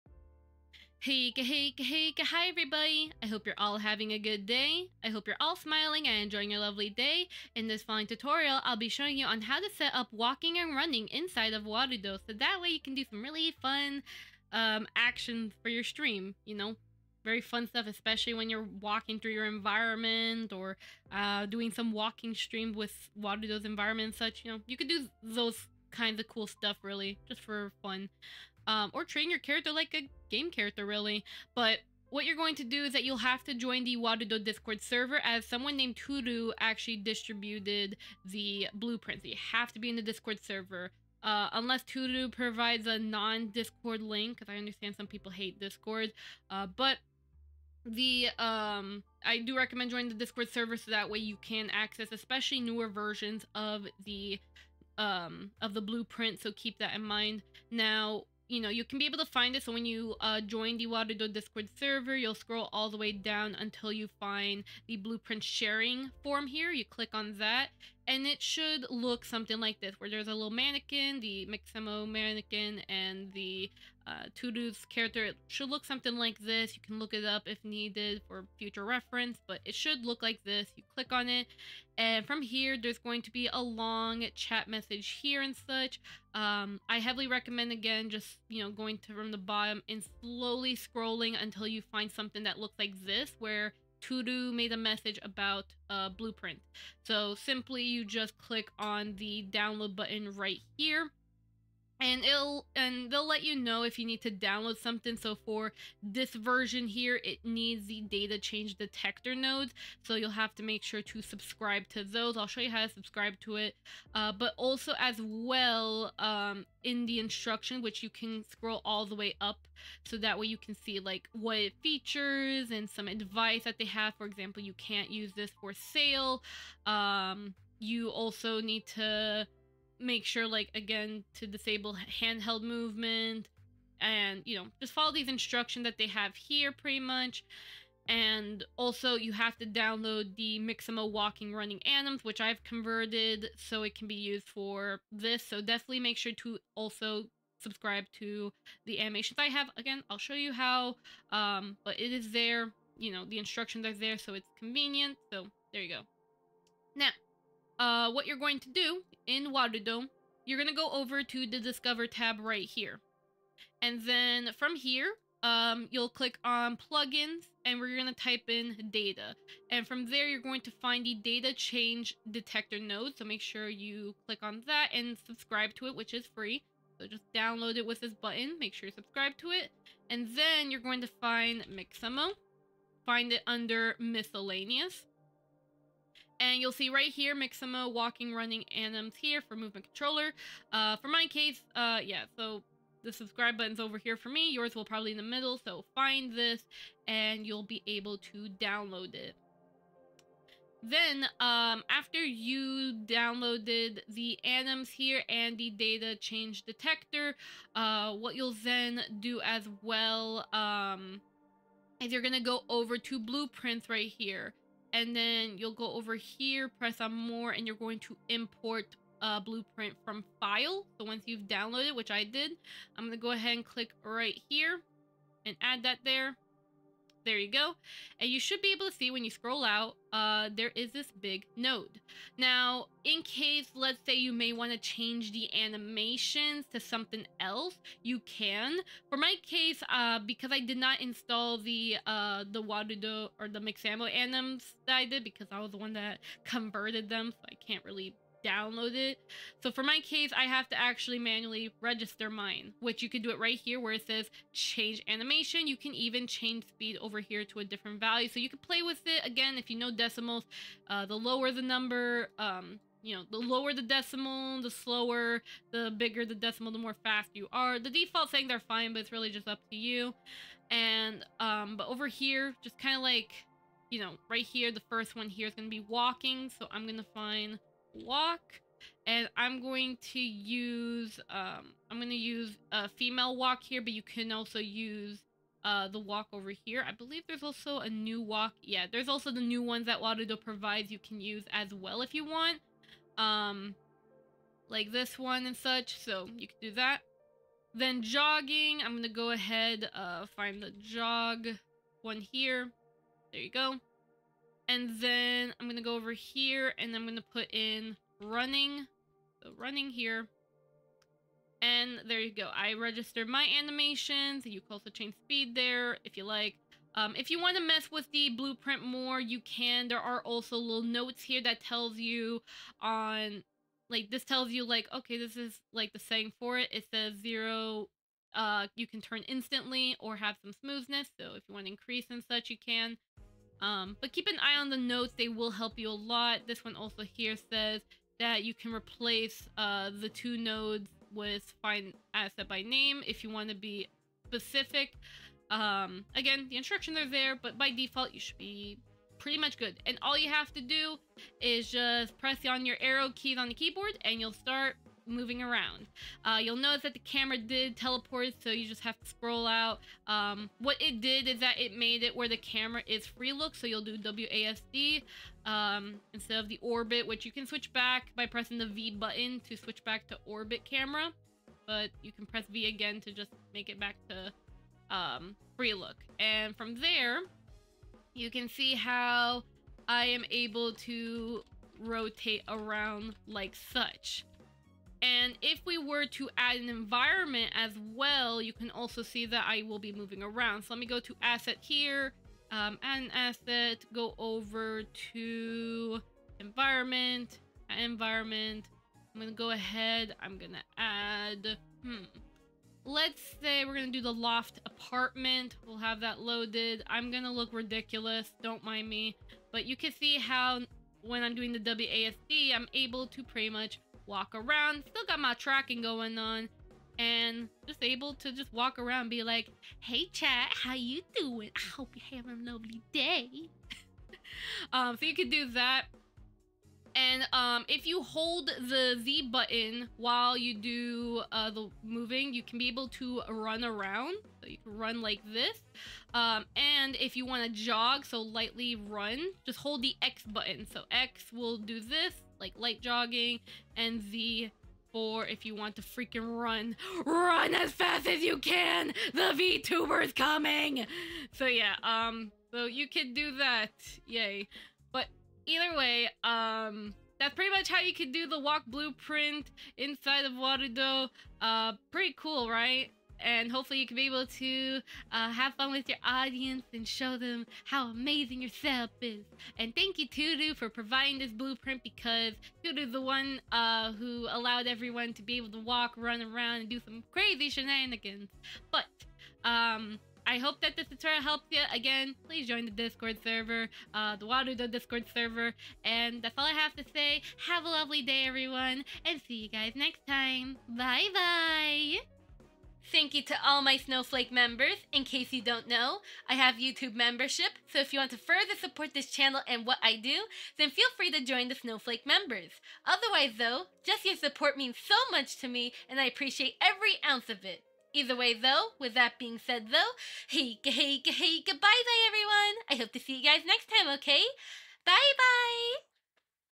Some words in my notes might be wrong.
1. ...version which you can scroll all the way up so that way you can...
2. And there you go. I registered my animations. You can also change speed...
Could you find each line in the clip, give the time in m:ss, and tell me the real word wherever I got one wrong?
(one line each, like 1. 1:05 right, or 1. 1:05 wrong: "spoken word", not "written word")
1. 1:57 wrong: "instruction", not "version"
2. 5:11 right.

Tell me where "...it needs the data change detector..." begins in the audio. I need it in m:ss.
1:47.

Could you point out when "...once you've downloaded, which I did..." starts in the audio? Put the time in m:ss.
3:41.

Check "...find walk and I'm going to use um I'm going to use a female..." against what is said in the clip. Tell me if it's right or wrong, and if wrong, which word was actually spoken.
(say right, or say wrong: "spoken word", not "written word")
right.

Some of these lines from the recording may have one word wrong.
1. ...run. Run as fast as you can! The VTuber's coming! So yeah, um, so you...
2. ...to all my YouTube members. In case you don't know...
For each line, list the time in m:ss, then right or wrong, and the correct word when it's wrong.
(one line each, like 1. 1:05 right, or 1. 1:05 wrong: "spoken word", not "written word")
1. 7:26 right
2. 8:13 wrong: "Snowflake", not "YouTube".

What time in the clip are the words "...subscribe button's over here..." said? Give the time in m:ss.
3:13.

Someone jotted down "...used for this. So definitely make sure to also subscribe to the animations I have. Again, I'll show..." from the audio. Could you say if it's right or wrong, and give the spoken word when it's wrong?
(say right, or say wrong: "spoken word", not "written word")
right.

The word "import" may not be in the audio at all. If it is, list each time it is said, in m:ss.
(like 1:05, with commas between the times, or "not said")
3:38.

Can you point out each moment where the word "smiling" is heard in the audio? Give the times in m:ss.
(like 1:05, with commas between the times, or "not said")
0:05.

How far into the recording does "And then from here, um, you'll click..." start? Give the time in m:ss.
2:43.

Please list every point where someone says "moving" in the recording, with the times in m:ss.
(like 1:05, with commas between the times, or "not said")
5:55, 6:29, 7:11.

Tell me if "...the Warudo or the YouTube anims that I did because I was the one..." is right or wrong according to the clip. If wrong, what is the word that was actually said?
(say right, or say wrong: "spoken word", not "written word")
wrong: "Mixamo", not "YouTube".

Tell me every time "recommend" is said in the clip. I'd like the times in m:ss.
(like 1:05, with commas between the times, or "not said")
0:49, 1:27.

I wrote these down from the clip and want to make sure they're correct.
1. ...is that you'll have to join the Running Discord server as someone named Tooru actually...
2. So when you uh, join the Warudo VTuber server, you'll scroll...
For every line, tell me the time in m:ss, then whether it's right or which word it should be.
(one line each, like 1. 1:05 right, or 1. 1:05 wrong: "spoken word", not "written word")
1. 0:32 wrong: "Warudo", not "Running"
2. 0:59 wrong: "Discord", not "VTuber".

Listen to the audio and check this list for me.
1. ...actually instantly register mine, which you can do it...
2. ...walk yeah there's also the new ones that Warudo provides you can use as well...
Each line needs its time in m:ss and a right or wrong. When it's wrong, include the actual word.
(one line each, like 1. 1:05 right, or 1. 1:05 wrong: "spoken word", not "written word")
1. 4:10 wrong: "manually", not "instantly"
2. 4:48 right.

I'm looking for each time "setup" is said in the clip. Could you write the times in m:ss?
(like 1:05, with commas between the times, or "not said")
7:48.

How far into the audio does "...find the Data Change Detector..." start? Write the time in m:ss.
2:50.